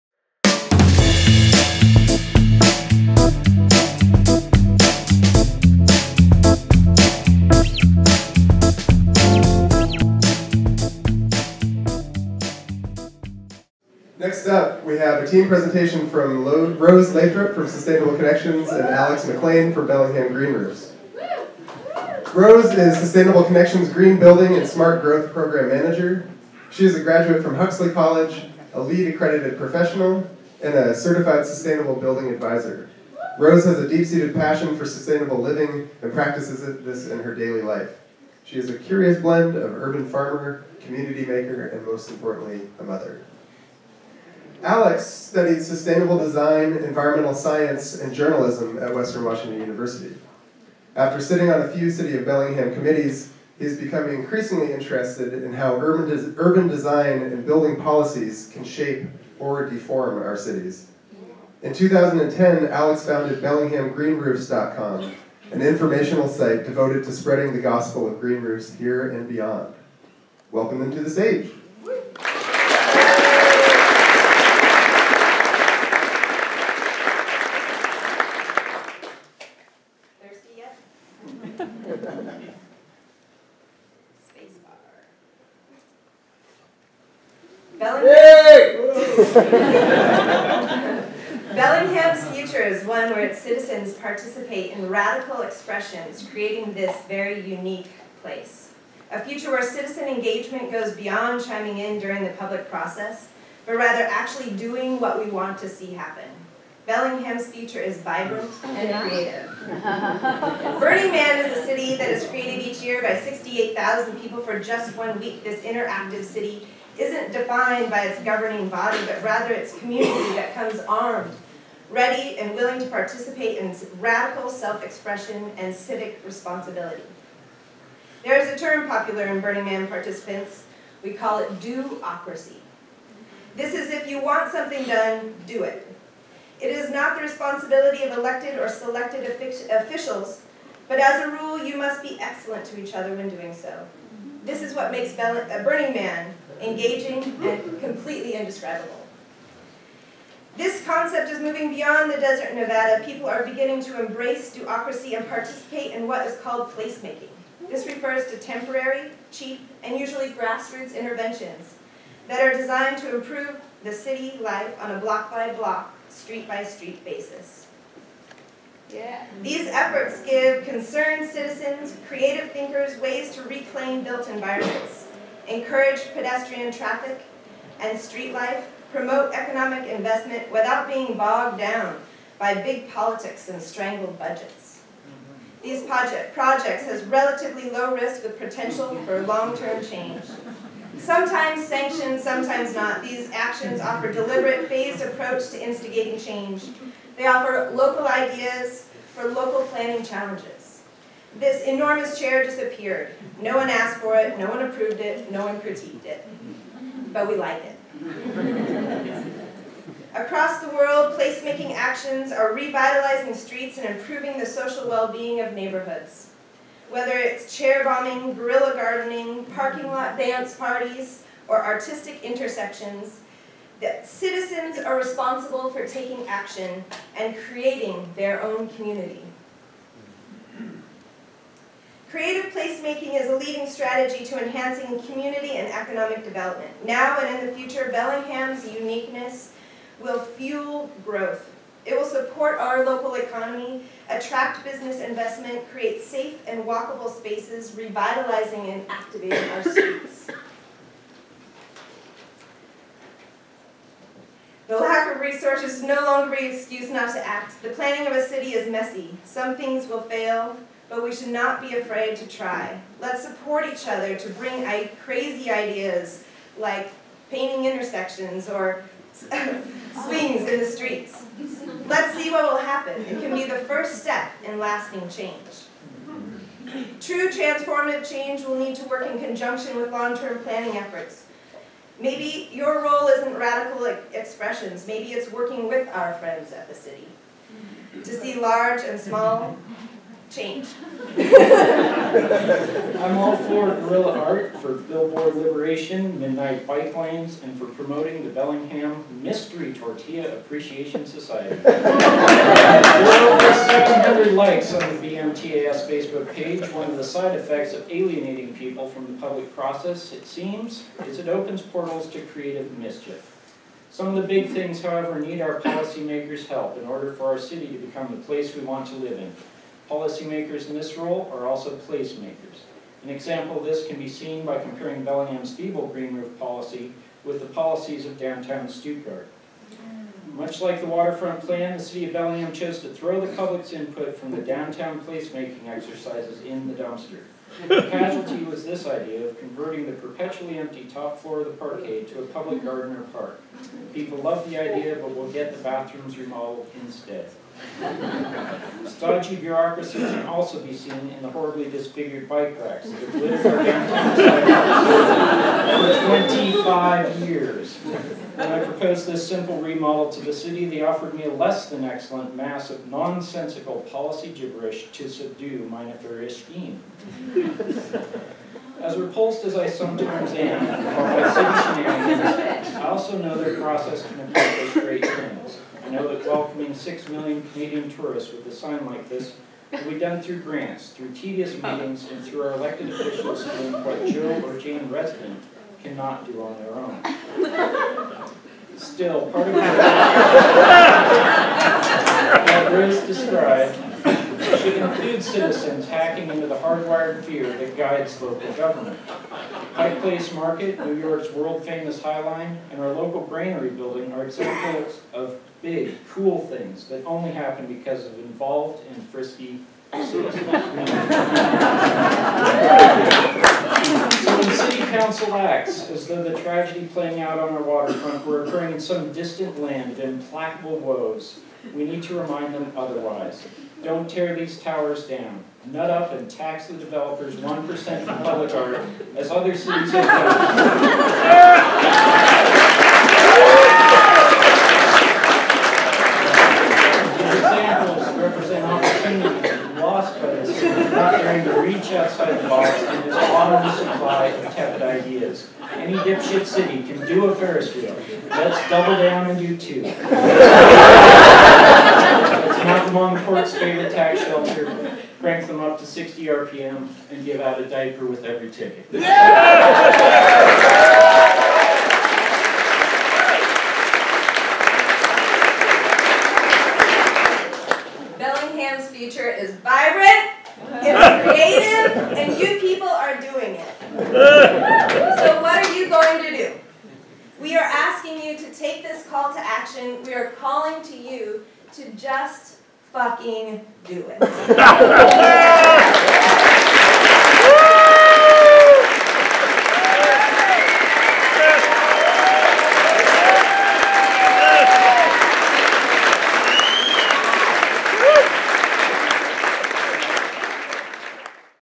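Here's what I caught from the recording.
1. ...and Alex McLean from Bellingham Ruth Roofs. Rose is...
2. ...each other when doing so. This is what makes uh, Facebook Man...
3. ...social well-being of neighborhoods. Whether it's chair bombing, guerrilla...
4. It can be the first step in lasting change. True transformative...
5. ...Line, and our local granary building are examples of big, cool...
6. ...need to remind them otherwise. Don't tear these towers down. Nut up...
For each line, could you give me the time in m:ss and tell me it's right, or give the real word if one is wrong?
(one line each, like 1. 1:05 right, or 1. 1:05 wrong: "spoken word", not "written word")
1. 0:18 wrong: "Green", not "Ruth"
2. 2:22 wrong: "Burning", not "Facebook"
3. 3:34 right
4. 4:33 right
5. 6:42 right
6. 7:01 right.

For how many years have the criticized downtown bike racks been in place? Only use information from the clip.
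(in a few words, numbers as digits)
25 years.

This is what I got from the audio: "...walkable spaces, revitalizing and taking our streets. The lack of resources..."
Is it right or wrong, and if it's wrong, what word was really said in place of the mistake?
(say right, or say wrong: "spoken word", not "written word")
wrong: "activating", not "taking".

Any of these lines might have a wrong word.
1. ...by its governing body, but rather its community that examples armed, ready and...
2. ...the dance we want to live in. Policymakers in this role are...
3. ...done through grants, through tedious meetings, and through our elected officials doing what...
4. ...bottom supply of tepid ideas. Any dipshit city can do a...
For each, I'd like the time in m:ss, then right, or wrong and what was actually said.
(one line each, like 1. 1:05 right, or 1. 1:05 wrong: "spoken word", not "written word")
1. 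1:57 wrong: "comes", not "examples"
2. 5:18 wrong: "place", not "dance"
3. 6:19 right
4. 7:23 right.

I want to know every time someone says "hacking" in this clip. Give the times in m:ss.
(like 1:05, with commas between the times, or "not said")
6:35.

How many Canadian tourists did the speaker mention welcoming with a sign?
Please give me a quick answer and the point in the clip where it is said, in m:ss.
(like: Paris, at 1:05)
6 million, at 6:16.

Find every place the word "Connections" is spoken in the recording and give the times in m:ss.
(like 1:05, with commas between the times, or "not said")
0:18, 0:23.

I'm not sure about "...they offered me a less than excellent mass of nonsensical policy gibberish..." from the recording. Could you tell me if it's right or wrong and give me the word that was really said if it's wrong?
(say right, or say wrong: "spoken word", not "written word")
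right.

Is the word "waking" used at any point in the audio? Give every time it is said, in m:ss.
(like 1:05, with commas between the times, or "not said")
not said.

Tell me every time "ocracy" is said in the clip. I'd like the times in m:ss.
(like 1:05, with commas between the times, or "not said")
2:11, 2:34.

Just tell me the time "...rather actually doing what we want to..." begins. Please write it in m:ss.
1:43.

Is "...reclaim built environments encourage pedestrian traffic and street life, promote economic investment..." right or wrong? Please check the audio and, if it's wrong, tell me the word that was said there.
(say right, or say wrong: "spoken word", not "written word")
right.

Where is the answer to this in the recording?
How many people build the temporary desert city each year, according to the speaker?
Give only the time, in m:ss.
1:53.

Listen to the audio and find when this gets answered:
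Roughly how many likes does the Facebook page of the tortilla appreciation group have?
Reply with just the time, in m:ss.
5:03.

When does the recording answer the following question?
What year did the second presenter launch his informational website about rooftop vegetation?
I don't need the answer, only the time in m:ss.
1:01.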